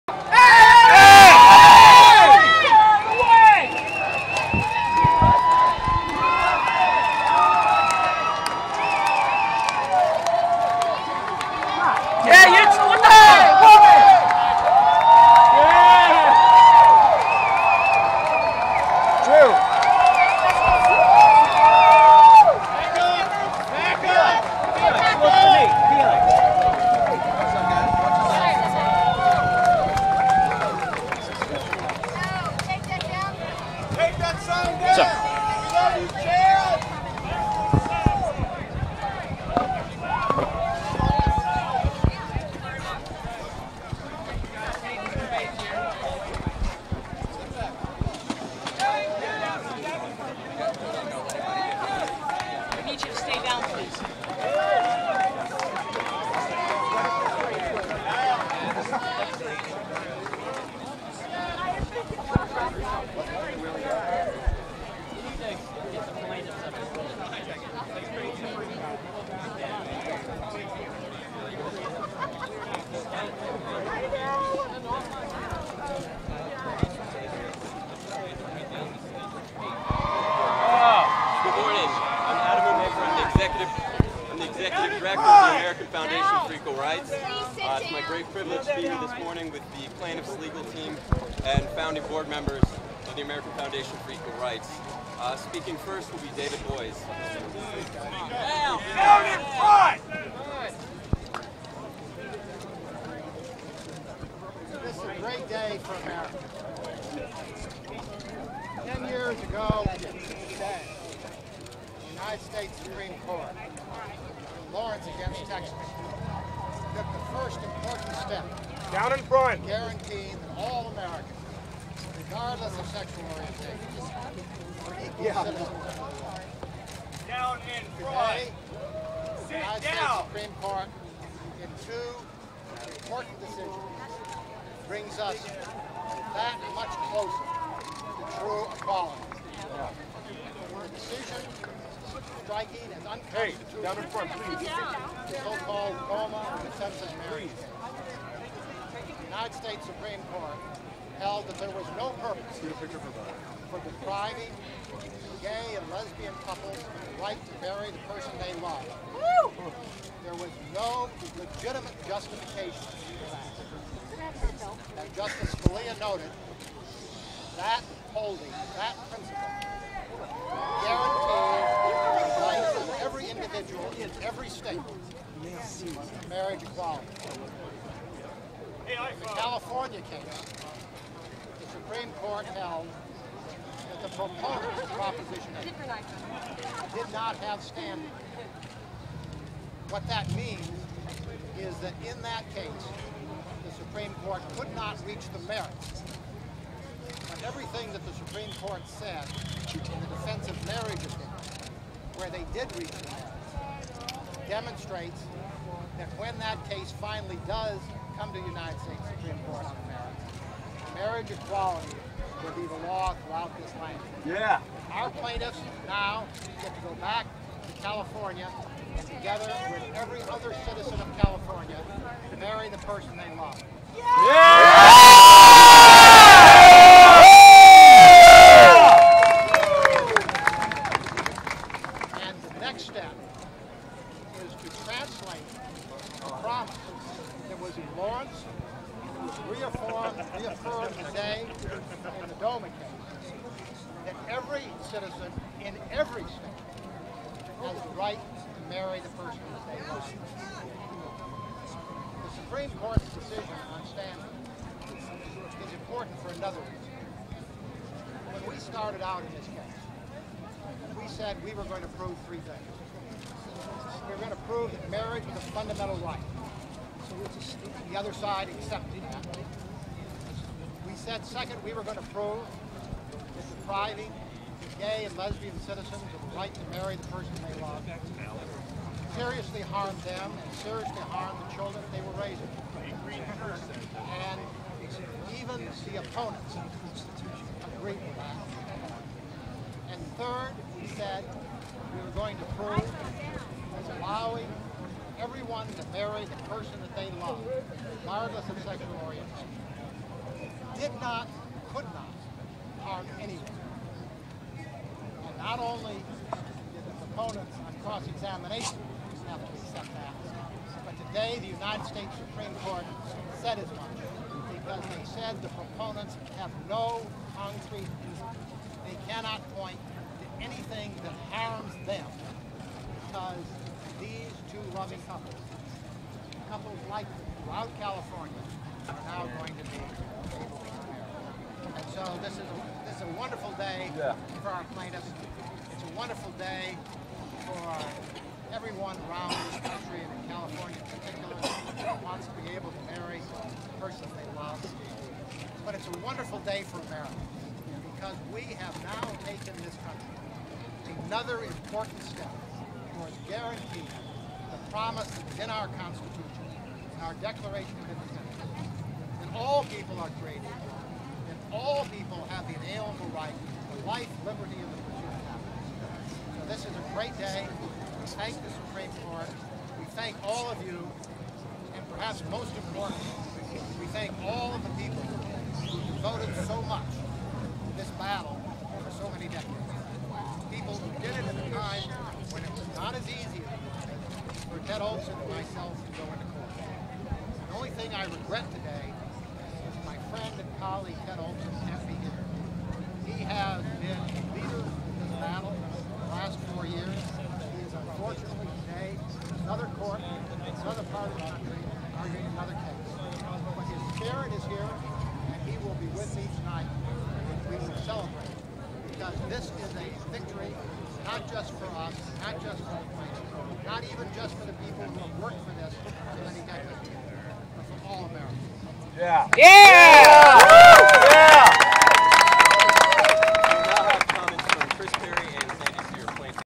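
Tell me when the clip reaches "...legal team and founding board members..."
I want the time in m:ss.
1:30.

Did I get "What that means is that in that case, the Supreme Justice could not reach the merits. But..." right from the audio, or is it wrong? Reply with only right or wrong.
wrong.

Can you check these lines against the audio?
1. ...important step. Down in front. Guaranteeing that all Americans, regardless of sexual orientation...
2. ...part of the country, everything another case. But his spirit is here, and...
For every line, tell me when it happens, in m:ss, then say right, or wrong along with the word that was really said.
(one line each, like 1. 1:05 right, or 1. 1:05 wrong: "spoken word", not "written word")
1. 1:57 right
2. 6:40 wrong: "arguing", not "everything".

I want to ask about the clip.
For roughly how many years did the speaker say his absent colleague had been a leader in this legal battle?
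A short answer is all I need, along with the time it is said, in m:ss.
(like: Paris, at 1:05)
4, at 6:36.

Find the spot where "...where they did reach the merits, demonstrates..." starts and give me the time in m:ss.
3:22.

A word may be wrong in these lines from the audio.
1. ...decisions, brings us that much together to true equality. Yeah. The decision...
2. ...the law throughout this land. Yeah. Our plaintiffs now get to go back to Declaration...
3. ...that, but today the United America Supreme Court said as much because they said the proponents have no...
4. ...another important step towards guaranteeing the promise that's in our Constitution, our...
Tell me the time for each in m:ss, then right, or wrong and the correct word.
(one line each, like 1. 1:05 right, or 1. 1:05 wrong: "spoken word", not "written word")
1. 2:13 wrong: "closer", not "together"
2. 3:32 wrong: "California", not "Declaration"
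3. 5:09 wrong: "States", not "America"
4. 5:51 right.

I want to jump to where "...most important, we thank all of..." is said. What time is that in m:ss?
6:12.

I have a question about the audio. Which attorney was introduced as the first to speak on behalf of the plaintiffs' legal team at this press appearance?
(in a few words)
David Boies.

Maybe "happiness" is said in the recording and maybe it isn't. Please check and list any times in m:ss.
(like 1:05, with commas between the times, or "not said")
6:05.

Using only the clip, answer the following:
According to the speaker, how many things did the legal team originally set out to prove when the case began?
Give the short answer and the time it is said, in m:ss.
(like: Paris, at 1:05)
3, at 4:22.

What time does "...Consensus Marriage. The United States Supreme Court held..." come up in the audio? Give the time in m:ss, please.
2:26.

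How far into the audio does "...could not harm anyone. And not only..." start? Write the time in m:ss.
5:01.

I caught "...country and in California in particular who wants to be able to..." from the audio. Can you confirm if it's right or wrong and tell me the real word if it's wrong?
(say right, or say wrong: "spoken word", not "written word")
right.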